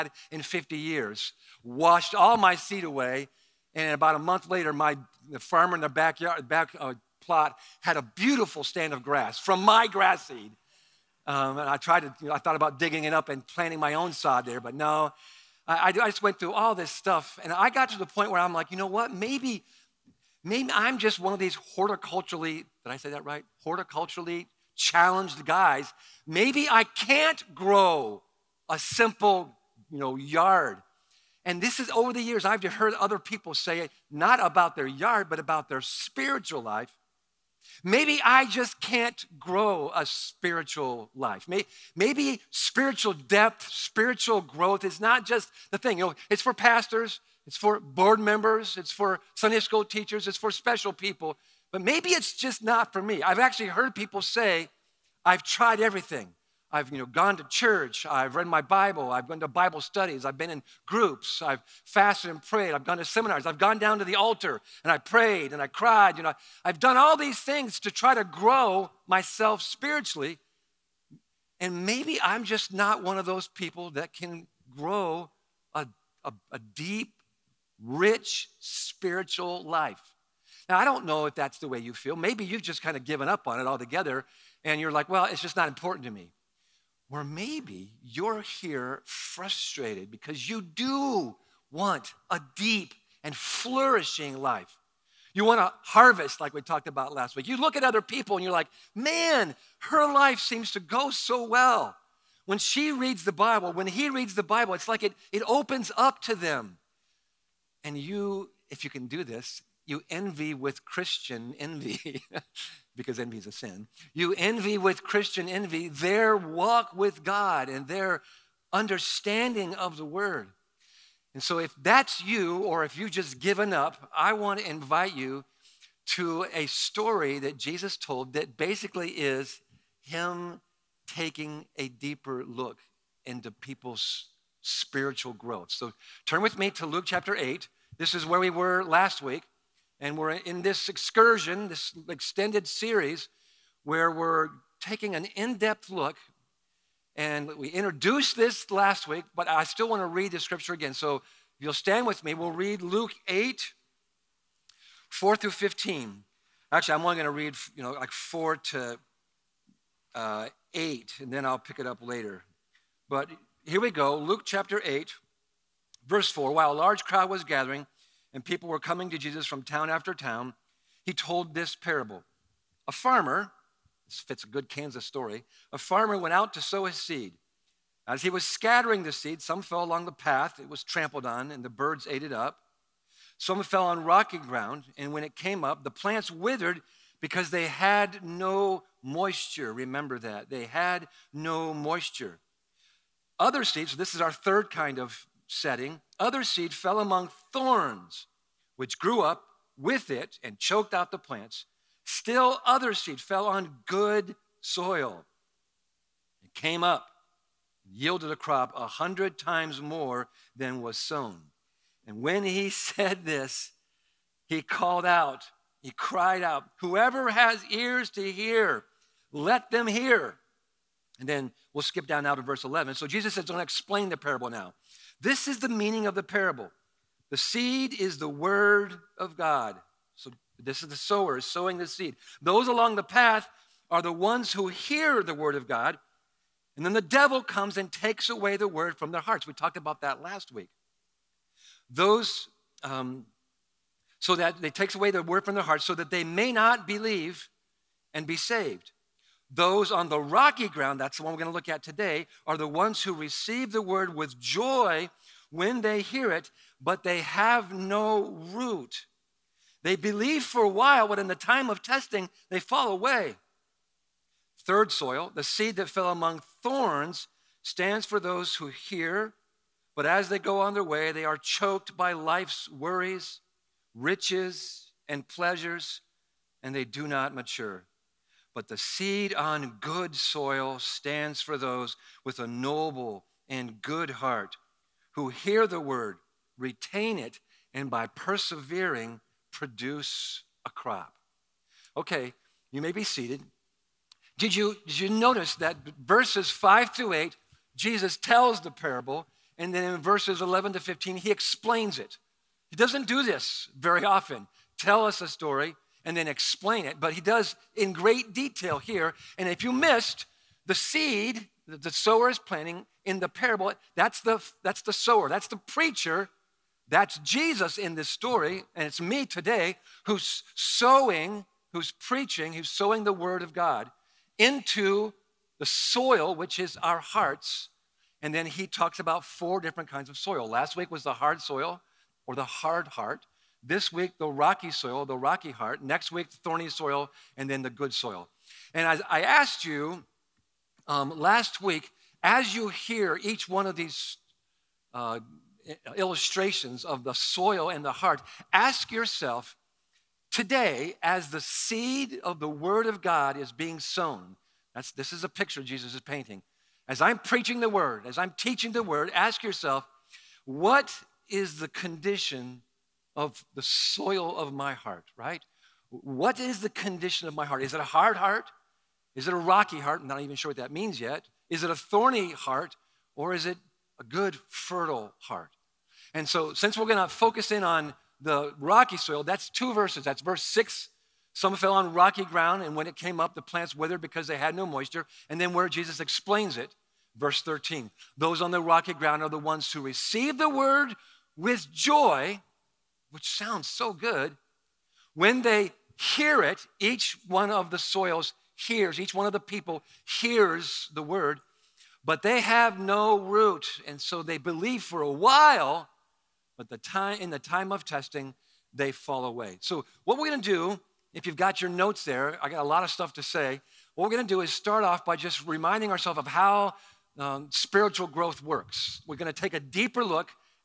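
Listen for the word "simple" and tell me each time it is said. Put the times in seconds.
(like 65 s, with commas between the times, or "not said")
28 s.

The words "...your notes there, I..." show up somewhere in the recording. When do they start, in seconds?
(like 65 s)
411 s.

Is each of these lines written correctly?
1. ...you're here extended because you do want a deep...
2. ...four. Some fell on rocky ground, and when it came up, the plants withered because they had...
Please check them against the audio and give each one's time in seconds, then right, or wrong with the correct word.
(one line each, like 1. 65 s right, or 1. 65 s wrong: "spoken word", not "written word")
1. 88 s wrong: "frustrated", not "extended"
2. 380 s wrong: "six", not "four".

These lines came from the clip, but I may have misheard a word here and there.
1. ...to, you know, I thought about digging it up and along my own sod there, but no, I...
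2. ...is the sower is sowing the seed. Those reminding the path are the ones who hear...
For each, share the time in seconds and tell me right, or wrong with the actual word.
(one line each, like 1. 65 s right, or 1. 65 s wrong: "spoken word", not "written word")
1. 12 s wrong: "planting", not "along"
2. 230 s wrong: "along", not "reminding".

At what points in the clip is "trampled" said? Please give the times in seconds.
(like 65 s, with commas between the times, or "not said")
180 s.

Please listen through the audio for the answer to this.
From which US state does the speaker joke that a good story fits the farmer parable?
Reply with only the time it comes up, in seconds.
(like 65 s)
174 s.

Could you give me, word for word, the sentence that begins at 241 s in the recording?
Those, um, so that they takes away the word from their hearts, so that they may not believe and be saved.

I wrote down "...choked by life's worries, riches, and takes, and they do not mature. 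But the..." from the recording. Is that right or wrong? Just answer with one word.
wrong.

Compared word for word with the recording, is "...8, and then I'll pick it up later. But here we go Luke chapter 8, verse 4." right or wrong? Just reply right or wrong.
right.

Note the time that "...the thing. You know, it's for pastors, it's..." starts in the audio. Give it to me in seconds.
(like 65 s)
45 s.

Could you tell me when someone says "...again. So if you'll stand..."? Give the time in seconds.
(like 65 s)
150 s.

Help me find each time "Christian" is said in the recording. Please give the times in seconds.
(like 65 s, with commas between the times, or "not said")
110 s, 115 s.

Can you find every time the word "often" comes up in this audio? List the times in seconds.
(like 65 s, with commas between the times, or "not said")
304 s.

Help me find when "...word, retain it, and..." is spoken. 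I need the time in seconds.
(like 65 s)
285 s.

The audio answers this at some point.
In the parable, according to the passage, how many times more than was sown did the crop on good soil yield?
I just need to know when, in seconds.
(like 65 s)
208 s.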